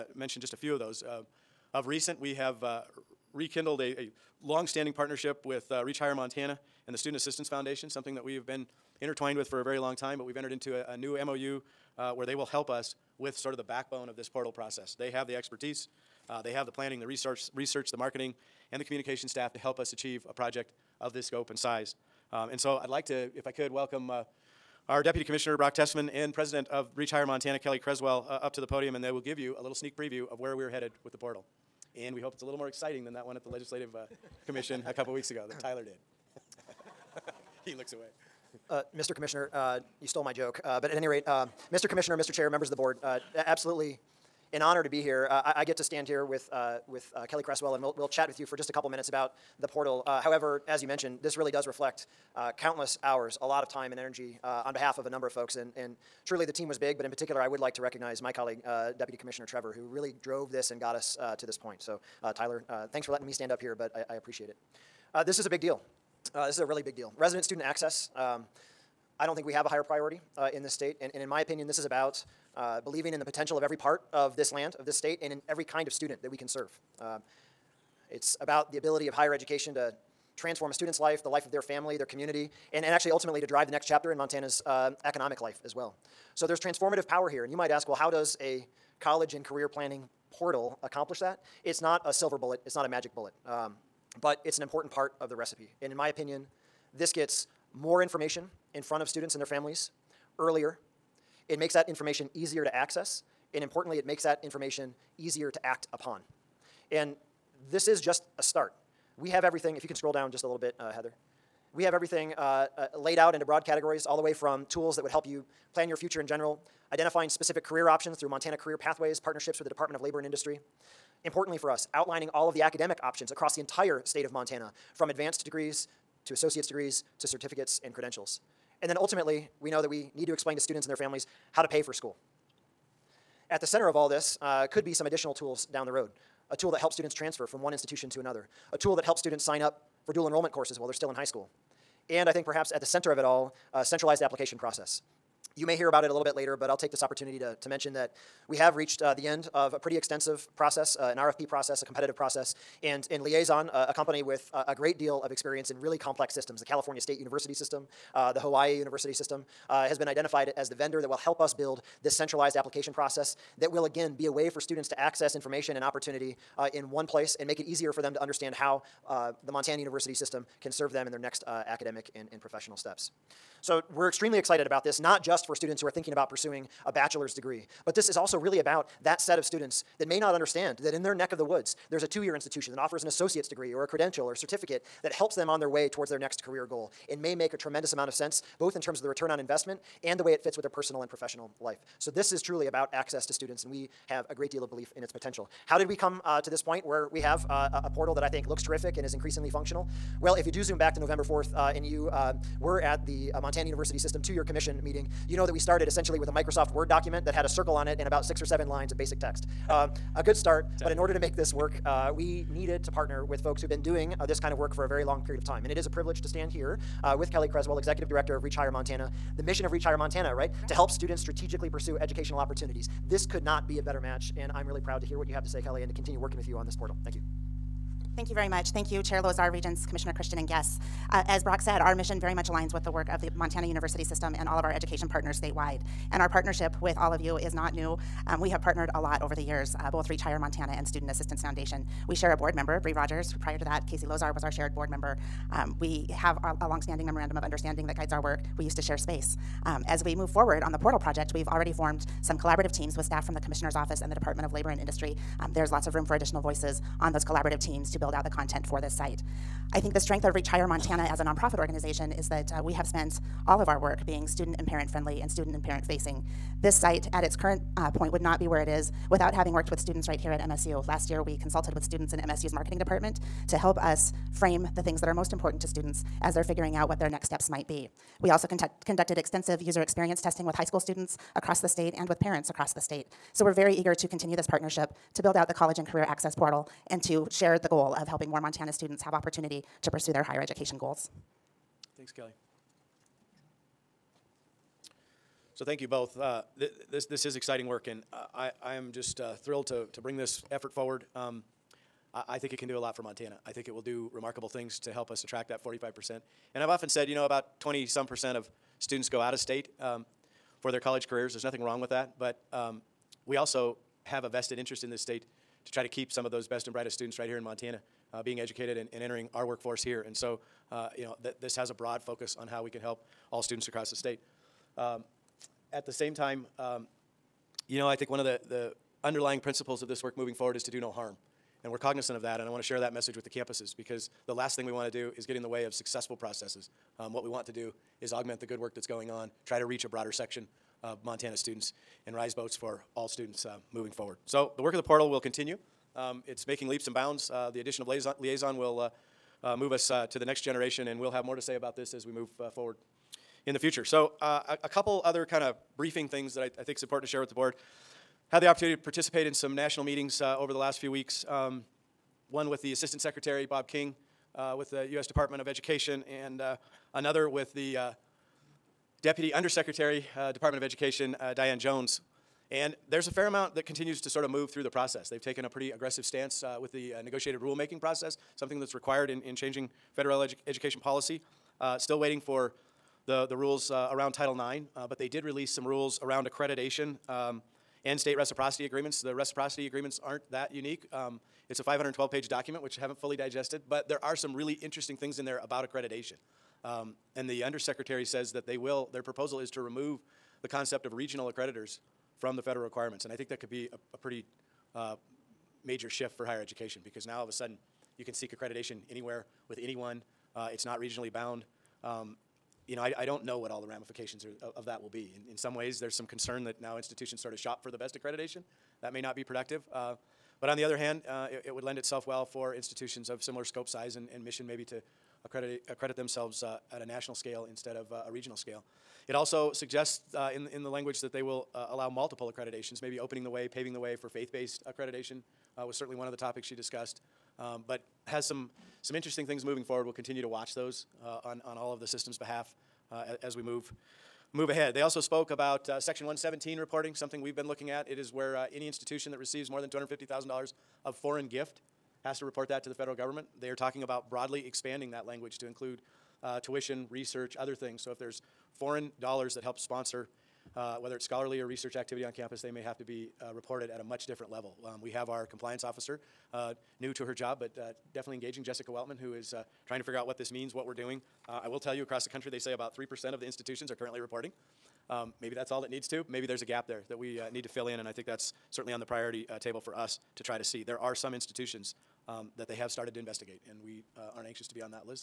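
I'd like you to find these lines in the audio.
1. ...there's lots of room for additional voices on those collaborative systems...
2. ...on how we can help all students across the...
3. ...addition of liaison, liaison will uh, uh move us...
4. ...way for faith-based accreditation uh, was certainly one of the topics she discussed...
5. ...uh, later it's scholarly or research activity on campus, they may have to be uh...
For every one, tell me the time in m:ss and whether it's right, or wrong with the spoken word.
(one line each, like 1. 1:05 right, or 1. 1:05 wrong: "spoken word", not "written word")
1. 4:15 wrong: "teams", not "systems"
2. 5:22 right
3. 5:47 right
4. 7:13 right
5. 7:40 wrong: "whether", not "later".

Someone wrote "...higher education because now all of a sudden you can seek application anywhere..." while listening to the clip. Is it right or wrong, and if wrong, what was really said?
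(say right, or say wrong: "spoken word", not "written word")
wrong: "accreditation", not "application".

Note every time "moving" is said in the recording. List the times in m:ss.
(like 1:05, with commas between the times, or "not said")
5:30, 5:43, 7:19.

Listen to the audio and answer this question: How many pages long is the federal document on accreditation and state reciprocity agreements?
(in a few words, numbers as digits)
512.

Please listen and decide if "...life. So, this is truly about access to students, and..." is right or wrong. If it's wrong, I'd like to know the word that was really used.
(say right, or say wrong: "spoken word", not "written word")
right.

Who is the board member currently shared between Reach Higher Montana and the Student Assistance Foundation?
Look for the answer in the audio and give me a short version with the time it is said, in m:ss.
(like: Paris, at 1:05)
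Bree Rogers, at 4:02.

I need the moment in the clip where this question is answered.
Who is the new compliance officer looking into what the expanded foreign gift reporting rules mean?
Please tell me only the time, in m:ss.
7:48.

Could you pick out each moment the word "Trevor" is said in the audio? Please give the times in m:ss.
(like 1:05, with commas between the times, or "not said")
0:59.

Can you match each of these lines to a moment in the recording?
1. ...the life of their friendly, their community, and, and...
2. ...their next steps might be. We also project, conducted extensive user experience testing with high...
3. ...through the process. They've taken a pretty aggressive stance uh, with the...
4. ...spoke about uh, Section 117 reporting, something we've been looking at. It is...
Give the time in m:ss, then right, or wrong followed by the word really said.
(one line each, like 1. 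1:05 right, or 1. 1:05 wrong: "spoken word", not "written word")
1. 1:21 wrong: "family", not "friendly"
2. 4:37 wrong: "conduct", not "project"
3. 6:14 right
4. 7:24 right.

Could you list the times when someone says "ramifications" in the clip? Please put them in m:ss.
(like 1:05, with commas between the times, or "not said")
6:53.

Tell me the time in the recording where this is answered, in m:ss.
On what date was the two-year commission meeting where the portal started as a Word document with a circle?
3:20.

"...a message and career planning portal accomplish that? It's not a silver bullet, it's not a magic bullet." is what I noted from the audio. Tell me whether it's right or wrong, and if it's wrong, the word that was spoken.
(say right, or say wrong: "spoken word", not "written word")
wrong: "college", not "message".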